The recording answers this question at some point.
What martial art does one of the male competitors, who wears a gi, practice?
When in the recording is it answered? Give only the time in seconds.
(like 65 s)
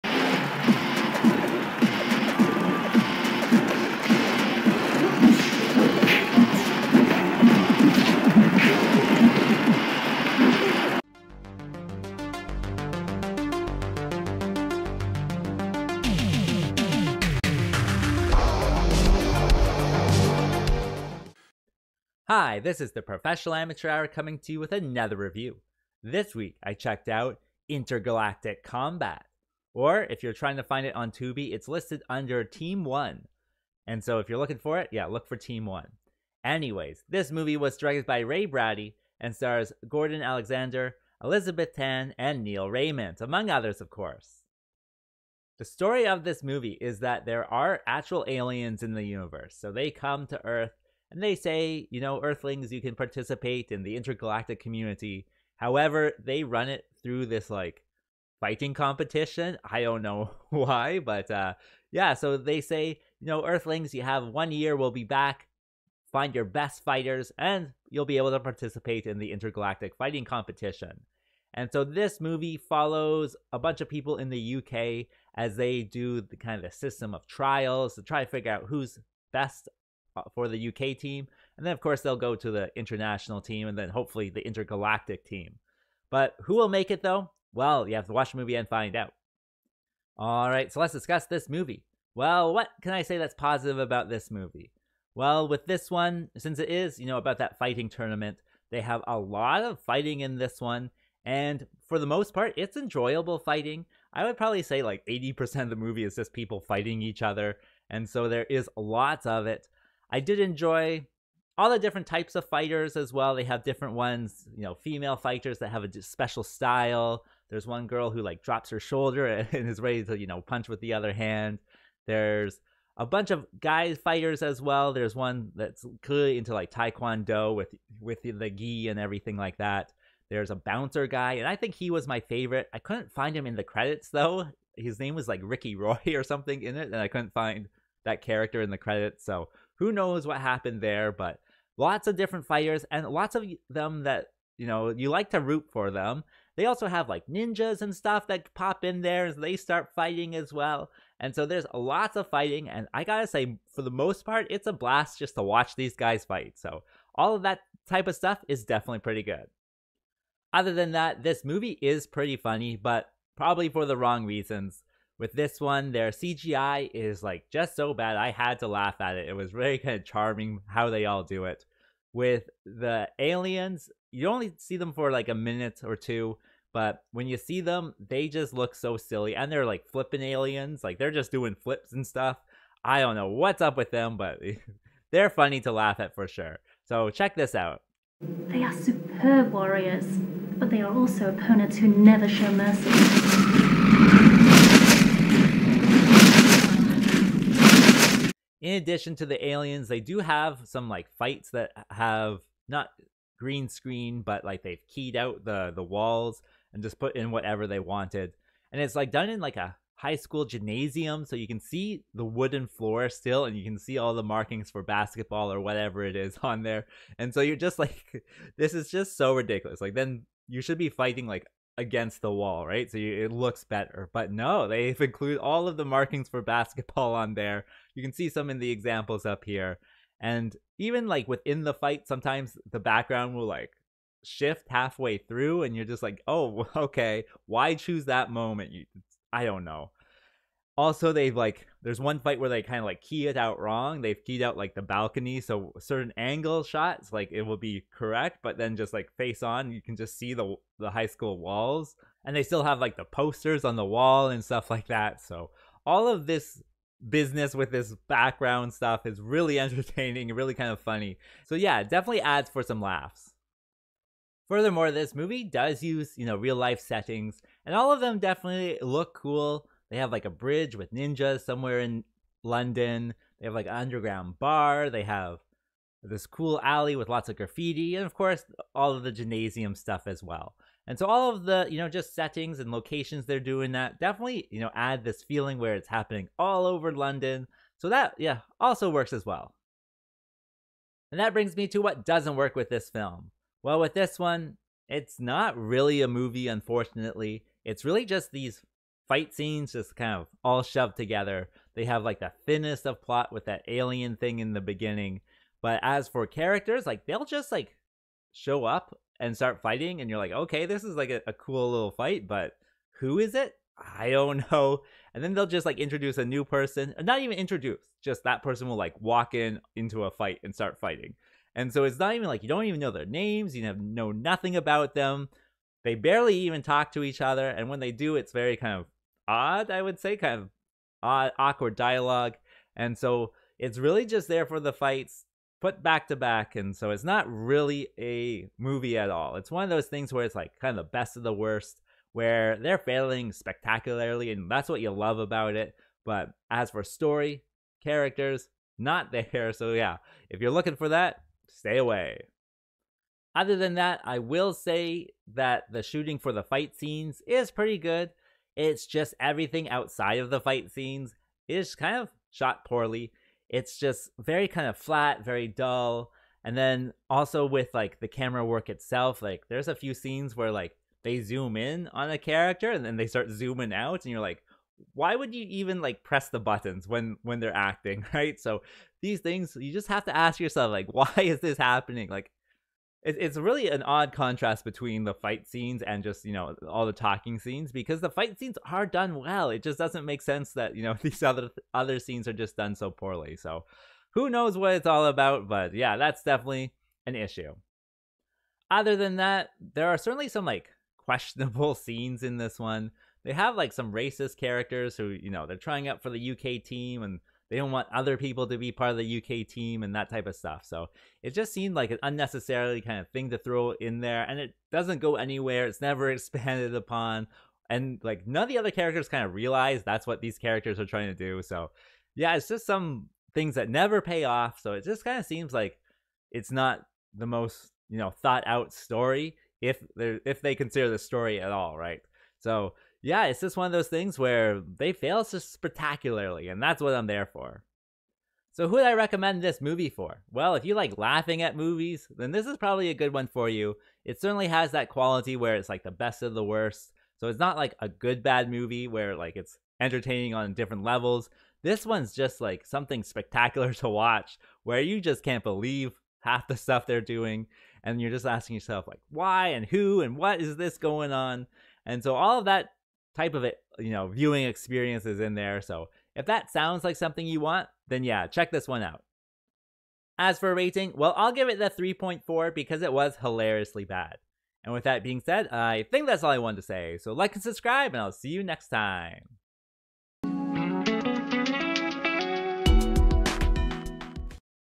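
126 s.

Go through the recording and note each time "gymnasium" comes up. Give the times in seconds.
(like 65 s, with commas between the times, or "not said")
210 s, 279 s.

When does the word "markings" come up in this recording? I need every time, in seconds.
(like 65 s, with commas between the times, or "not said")
214 s, 225 s.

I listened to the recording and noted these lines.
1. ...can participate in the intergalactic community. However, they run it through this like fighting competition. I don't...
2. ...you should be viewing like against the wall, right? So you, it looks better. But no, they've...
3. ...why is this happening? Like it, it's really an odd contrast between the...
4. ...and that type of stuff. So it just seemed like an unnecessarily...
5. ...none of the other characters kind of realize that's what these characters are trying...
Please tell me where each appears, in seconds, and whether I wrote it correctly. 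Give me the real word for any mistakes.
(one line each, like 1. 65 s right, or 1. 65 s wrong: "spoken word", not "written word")
1. 52 s right
2. 220 s wrong: "fighting", not "viewing"
3. 380 s right
4. 409 s right
5. 418 s right.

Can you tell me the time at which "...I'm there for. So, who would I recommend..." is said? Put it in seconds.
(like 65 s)
436 s.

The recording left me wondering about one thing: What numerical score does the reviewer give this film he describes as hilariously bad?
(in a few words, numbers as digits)
3.4.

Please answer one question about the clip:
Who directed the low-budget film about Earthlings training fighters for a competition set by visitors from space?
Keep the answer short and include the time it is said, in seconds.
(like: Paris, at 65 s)
Ray Brady, at 38 s.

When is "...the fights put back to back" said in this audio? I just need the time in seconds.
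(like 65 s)
334 s.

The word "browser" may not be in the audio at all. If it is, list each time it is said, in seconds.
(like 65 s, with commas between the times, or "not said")
not said.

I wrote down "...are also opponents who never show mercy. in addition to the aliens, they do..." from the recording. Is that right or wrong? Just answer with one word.
right.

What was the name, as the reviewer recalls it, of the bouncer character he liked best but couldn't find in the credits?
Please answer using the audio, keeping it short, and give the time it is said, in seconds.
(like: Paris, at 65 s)
Ricky Roy, at 135 s.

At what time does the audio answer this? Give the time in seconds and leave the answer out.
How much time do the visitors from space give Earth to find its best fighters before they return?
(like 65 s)
64 s.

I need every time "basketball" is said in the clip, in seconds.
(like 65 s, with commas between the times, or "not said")
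214 s, 226 s.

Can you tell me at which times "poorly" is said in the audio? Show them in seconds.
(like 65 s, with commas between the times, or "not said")
362 s, 392 s.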